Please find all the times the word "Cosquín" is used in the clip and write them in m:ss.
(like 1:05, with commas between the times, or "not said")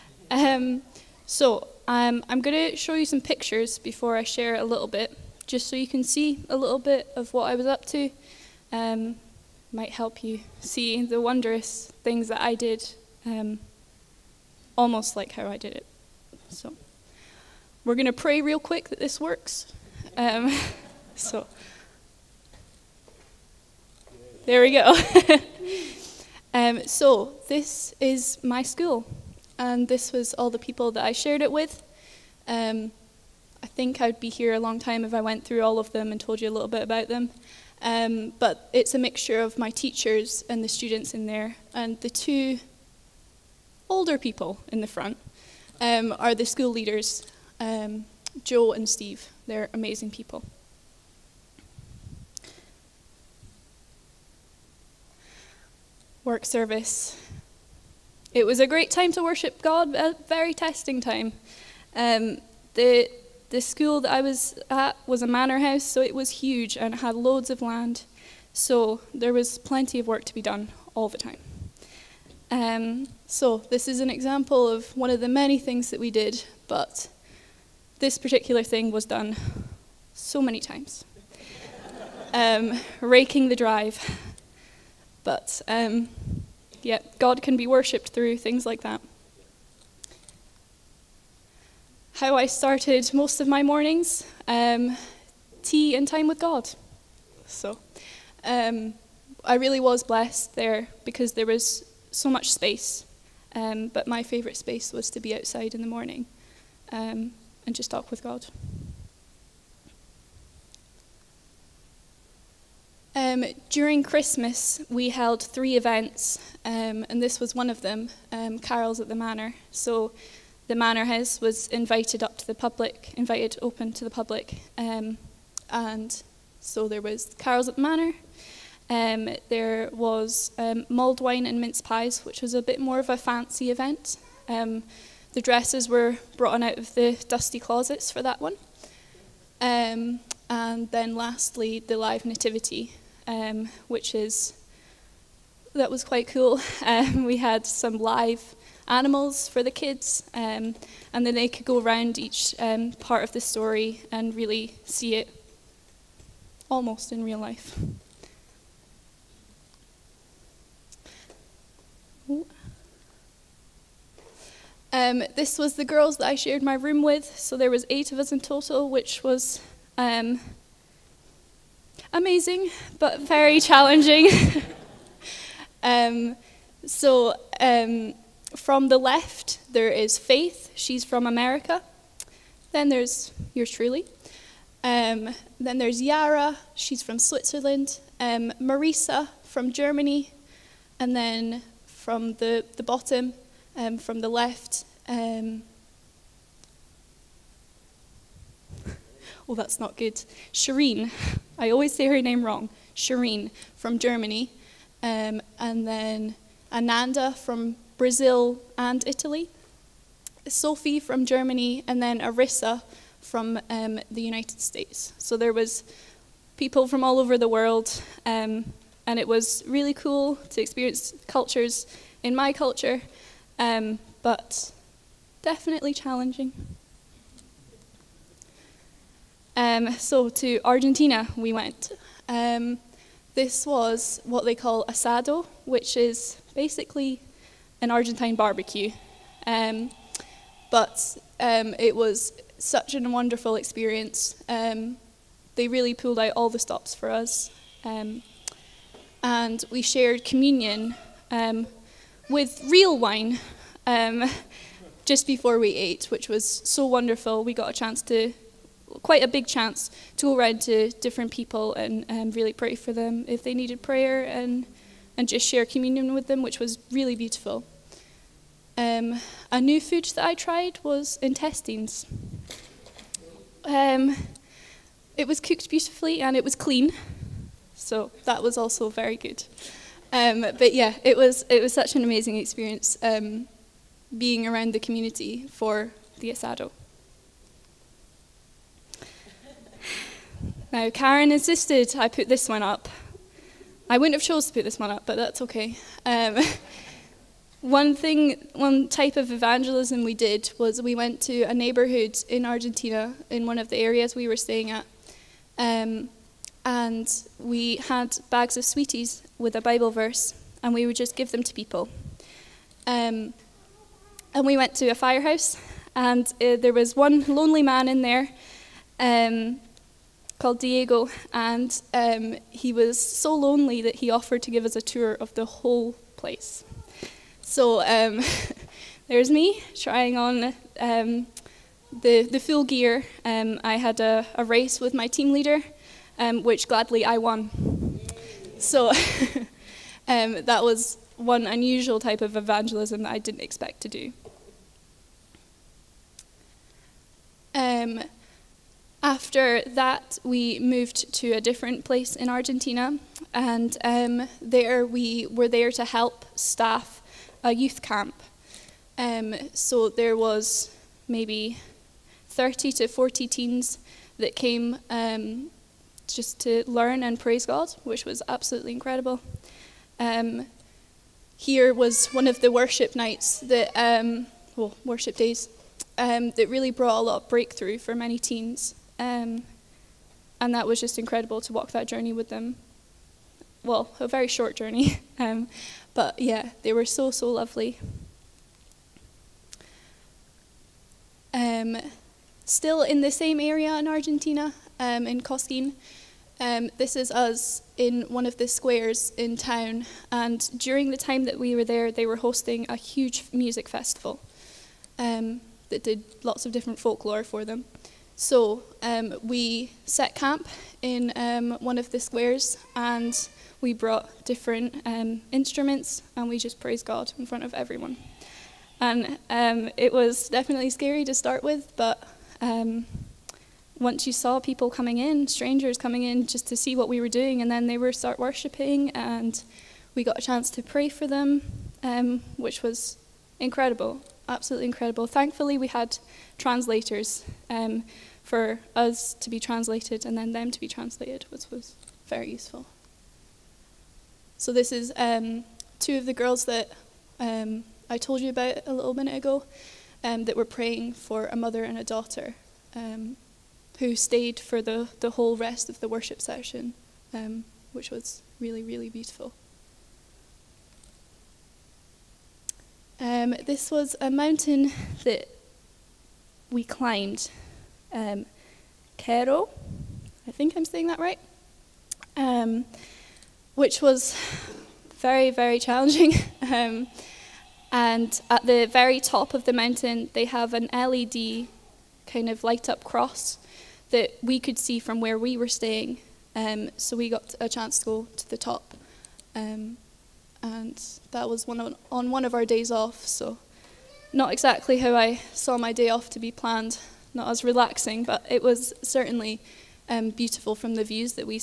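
6:35.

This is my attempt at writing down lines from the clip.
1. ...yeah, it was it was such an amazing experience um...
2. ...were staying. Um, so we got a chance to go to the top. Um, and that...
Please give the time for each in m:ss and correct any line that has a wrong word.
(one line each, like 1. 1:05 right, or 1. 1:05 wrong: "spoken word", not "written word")
1. 4:40 right
2. 8:05 right.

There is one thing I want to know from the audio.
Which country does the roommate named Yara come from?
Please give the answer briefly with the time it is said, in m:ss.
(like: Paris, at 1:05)
Switzerland, at 3:07.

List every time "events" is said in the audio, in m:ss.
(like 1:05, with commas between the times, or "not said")
1:55, 2:13.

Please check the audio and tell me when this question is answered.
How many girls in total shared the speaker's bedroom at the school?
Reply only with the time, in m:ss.
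2:47.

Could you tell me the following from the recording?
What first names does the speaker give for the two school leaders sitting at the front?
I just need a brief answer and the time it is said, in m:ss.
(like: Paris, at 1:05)
Joe and Steve, at 0:48.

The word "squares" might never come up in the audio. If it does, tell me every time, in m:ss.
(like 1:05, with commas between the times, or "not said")
6:38, 6:52.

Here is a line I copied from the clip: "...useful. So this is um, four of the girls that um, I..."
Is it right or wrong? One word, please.
wrong.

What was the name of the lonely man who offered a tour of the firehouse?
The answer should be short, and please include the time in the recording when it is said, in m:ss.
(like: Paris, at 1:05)
Diego, at 5:20.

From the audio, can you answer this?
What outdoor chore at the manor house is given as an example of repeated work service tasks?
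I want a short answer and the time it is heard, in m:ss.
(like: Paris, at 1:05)
Raking the drive, at 1:23.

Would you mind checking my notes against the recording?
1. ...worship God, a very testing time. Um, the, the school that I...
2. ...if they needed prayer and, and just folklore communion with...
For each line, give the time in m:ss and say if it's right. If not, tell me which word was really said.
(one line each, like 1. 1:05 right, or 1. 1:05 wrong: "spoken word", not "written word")
1. 0:59 right
2. 4:23 wrong: "share", not "folklore".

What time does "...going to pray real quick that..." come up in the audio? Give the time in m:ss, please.
0:17.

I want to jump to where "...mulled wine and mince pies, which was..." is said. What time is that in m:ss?
2:10.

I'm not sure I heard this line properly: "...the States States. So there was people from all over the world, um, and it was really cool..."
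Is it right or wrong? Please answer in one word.
wrong.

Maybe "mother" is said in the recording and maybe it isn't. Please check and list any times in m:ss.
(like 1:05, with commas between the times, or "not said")
7:31.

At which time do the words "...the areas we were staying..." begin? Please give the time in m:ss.
5:03.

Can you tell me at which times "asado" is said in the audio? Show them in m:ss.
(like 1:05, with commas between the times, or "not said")
3:54, 4:46.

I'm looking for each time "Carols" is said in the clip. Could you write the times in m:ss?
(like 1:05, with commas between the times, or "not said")
1:58, 2:07.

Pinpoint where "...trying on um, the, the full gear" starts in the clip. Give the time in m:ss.
5:29.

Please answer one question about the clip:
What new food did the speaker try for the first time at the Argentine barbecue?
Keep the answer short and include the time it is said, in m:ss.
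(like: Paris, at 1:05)
Intestines, at 4:31.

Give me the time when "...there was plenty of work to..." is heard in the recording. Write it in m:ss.
1:09.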